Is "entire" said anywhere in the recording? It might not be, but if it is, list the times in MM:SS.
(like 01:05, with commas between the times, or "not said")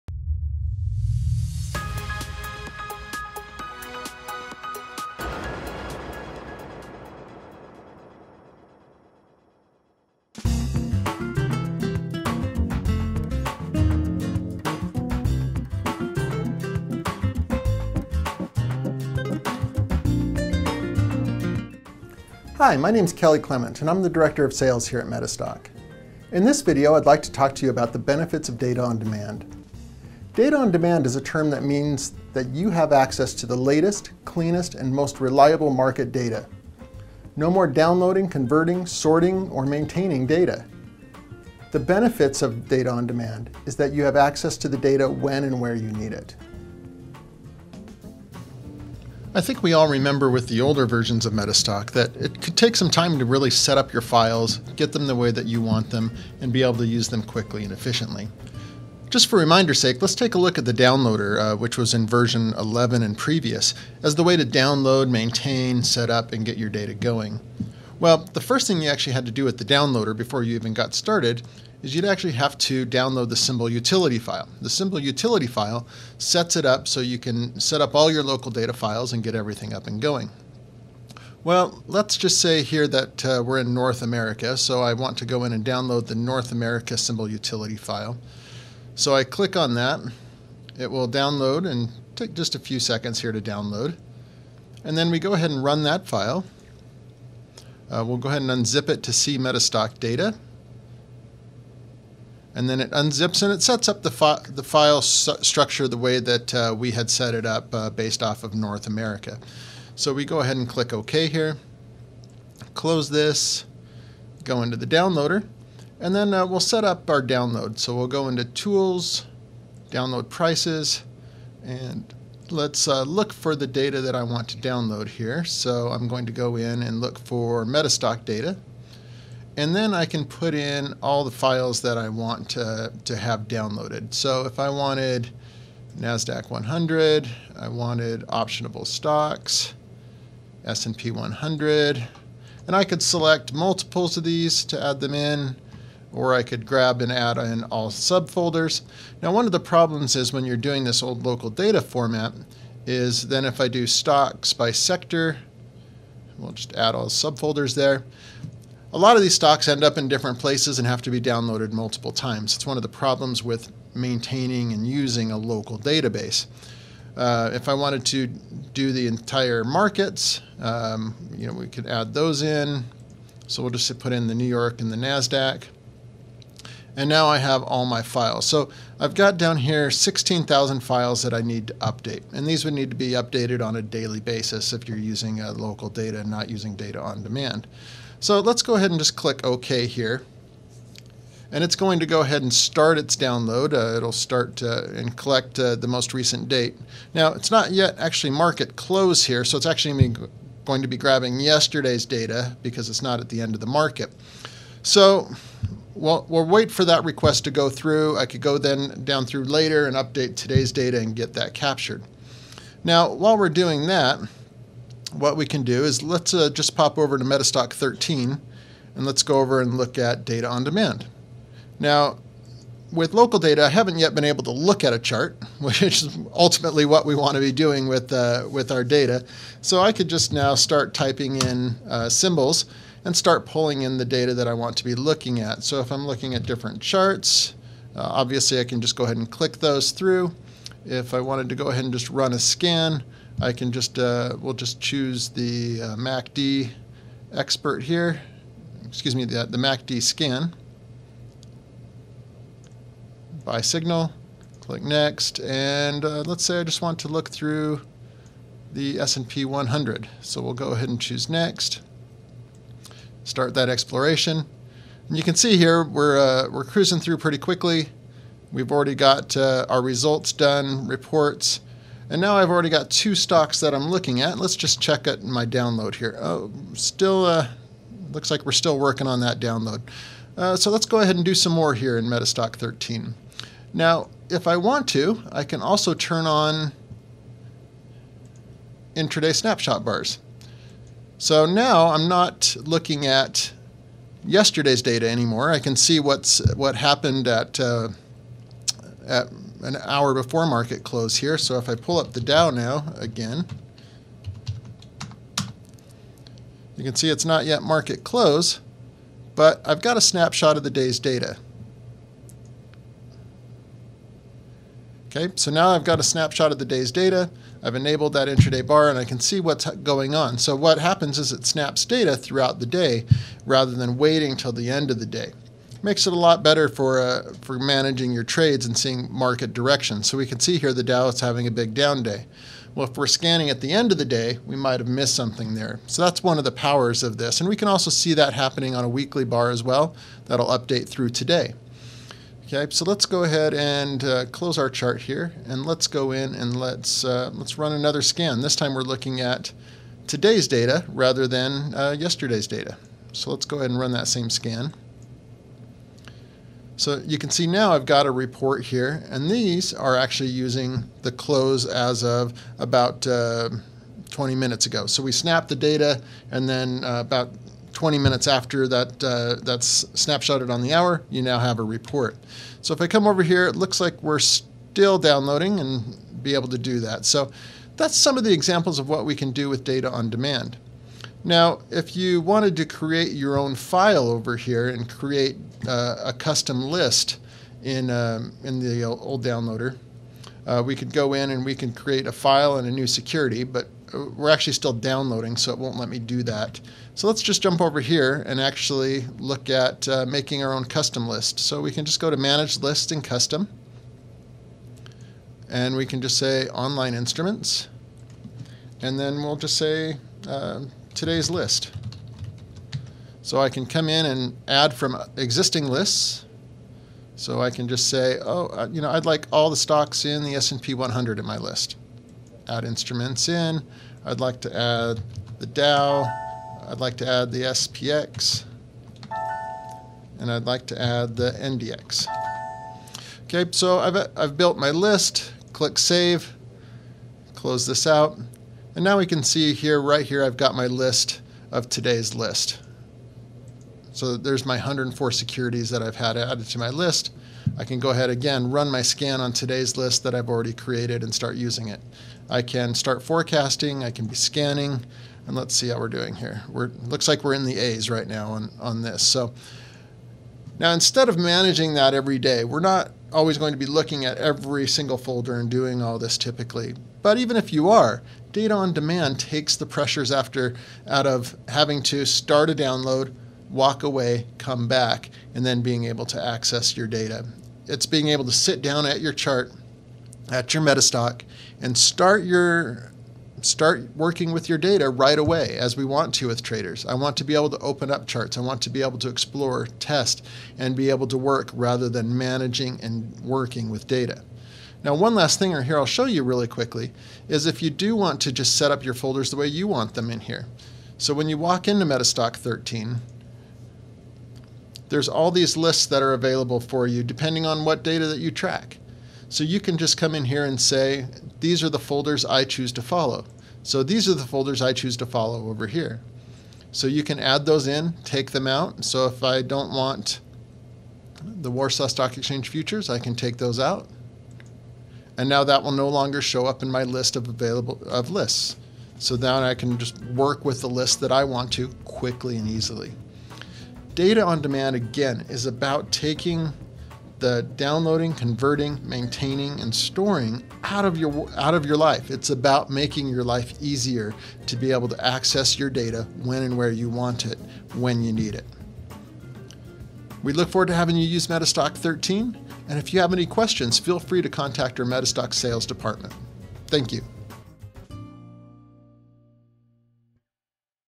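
02:49.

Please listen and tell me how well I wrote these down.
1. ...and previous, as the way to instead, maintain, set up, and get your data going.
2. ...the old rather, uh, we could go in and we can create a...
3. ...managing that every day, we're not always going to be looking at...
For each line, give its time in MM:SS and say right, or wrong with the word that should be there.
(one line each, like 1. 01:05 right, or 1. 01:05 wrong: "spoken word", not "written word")
1. 01:03 wrong: "download", not "instead"
2. 06:28 wrong: "downloader", not "rather"
3. 07:41 right.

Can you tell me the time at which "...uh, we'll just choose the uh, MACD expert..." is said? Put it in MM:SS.
04:03.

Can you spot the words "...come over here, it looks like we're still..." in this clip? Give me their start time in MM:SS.
06:12.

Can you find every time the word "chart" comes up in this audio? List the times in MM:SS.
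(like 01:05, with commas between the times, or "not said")
03:44, 03:56, 05:44, 07:59, 08:08.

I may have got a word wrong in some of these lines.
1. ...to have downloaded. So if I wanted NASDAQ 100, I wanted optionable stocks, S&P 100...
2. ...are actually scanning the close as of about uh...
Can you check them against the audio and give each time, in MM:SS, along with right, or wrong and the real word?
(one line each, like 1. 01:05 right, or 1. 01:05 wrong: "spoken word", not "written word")
1. 02:13 right
2. 05:59 wrong: "using", not "scanning".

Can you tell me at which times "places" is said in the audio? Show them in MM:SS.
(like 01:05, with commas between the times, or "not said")
02:40.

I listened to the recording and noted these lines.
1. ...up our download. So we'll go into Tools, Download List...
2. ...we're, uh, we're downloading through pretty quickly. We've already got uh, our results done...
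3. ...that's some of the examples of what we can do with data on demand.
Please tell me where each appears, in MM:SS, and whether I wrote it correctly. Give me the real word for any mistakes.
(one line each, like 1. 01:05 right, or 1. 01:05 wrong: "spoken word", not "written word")
1. 01:56 wrong: "Prices", not "List"
2. 04:25 wrong: "cruising", not "downloading"
3. 06:17 right.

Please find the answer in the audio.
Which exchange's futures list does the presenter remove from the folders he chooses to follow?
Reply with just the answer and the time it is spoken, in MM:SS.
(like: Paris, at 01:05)
Warsaw Stock Exchange, at 08:41.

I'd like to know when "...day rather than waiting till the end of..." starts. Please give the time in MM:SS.
05:22.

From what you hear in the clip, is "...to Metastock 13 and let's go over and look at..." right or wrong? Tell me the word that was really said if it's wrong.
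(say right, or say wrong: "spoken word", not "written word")
right.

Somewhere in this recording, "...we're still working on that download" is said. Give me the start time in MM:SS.
04:38.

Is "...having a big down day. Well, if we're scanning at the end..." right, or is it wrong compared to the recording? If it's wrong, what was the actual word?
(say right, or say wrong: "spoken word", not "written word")
right.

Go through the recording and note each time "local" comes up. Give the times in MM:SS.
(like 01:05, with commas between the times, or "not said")
01:18, 02:31, 02:45, 03:05, 03:43.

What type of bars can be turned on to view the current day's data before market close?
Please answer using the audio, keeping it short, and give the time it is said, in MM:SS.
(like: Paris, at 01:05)
intraday snapshot bars, at 04:48.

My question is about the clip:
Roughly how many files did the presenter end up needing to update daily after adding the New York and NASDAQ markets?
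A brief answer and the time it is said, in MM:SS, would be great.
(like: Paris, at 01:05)
16,000, at 02:59.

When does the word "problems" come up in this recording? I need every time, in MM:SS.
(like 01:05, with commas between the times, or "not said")
02:29, 02:42.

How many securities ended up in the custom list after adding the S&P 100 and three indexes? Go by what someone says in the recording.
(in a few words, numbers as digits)
104.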